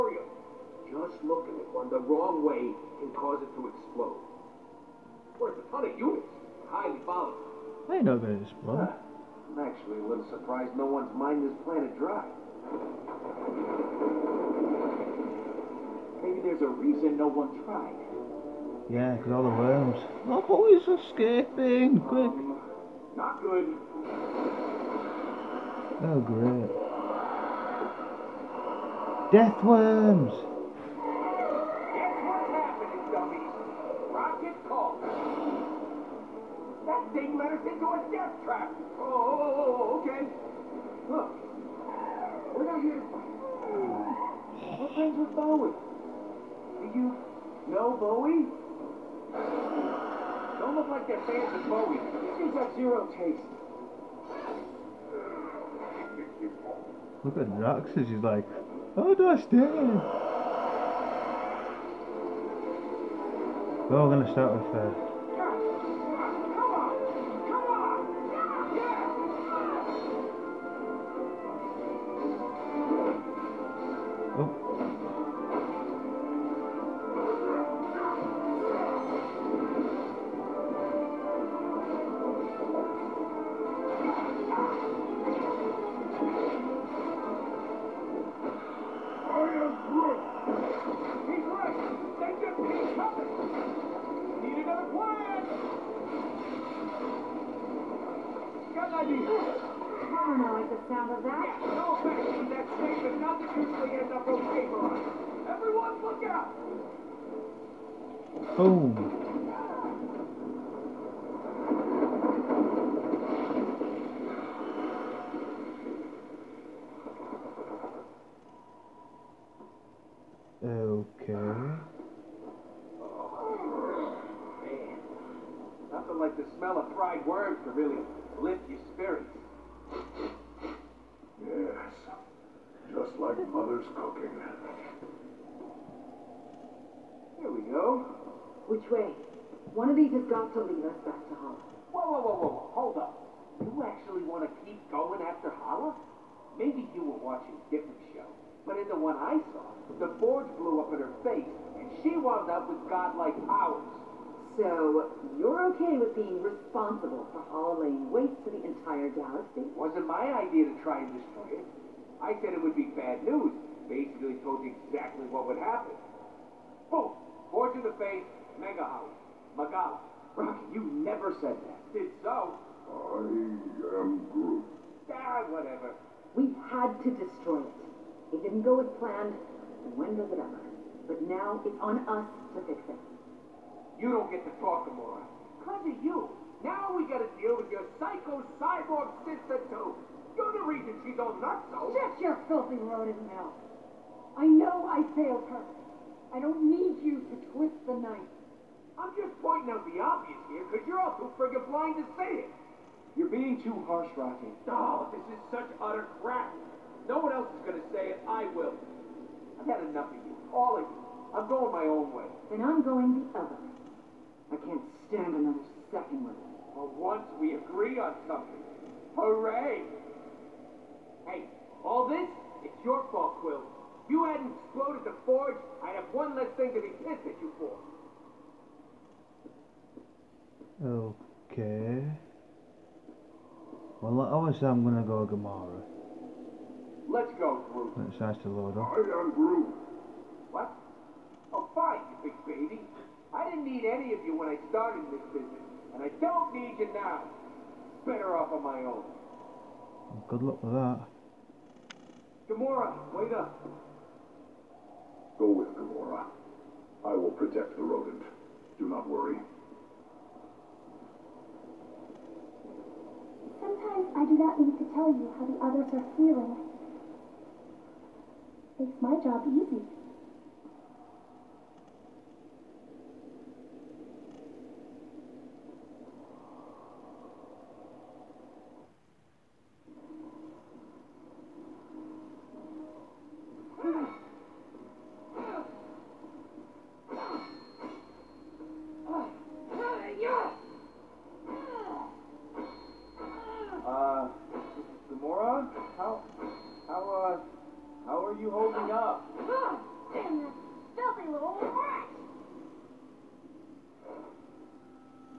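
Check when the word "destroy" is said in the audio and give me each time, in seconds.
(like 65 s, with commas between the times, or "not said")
161 s, 177 s.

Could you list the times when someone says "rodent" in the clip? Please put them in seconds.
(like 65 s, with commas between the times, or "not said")
192 s, 257 s.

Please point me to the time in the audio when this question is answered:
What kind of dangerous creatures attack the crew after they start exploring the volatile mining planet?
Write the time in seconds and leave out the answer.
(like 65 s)
29 s.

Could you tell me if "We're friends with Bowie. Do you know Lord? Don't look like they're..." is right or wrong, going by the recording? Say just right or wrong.
wrong.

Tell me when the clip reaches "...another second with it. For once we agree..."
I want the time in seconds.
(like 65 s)
215 s.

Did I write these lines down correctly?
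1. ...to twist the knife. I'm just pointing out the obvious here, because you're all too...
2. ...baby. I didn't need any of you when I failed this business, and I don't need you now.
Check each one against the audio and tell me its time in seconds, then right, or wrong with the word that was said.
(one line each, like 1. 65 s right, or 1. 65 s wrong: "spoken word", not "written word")
1. 197 s right
2. 242 s wrong: "started", not "failed".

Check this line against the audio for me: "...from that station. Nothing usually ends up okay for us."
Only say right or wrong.
right.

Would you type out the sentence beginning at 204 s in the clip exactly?
No, oh, this is such utter crap.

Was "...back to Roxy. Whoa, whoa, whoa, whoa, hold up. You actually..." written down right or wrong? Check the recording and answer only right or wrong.
wrong.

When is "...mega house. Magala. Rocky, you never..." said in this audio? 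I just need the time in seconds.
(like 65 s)
168 s.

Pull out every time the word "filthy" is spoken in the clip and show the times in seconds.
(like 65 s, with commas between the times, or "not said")
192 s, 300 s.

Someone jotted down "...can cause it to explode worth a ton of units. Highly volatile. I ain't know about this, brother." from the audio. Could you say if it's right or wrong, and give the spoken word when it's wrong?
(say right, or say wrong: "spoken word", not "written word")
right.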